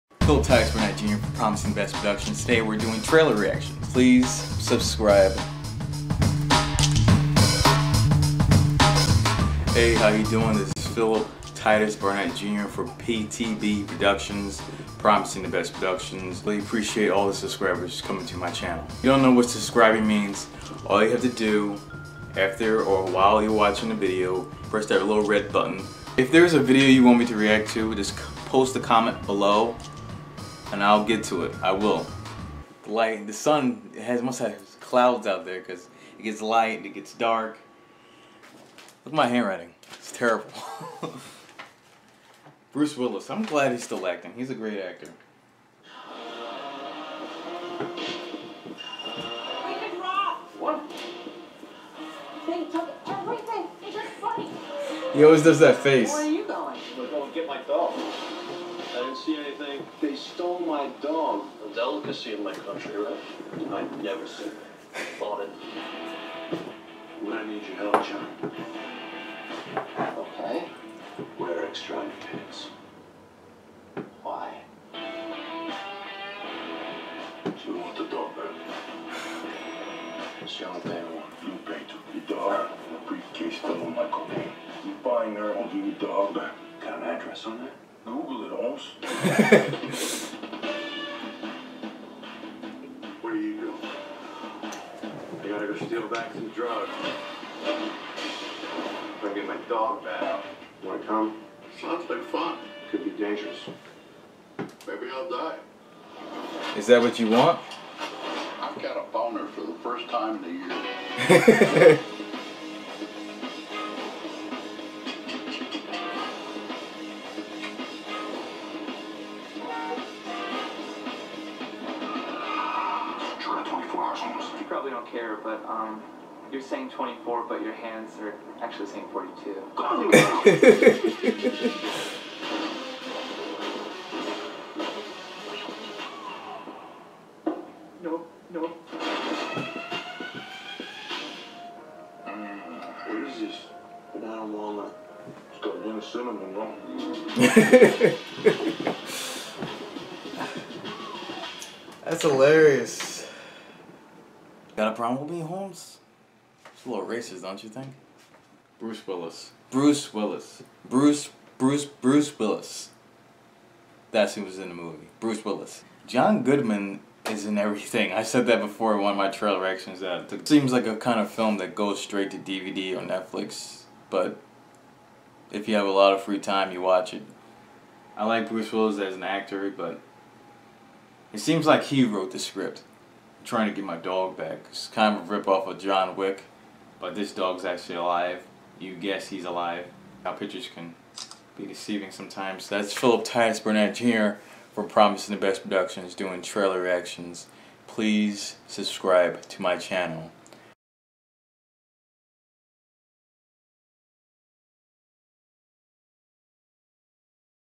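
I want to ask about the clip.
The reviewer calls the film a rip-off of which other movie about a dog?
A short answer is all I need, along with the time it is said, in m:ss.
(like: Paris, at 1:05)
John Wick, at 3:05.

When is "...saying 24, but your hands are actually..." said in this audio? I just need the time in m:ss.
2:06.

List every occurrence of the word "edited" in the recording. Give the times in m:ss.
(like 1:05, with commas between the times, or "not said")
not said.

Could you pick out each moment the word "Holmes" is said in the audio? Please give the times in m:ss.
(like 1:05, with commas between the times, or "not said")
1:28, 2:35.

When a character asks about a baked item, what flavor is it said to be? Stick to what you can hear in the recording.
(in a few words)
Banana walnut.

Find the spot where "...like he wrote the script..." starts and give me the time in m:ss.
3:01.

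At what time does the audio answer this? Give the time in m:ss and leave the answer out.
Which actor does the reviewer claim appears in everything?
2:46.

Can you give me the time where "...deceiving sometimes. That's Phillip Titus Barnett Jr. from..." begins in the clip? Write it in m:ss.
3:11.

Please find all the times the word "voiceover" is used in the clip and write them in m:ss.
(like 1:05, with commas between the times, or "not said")
not said.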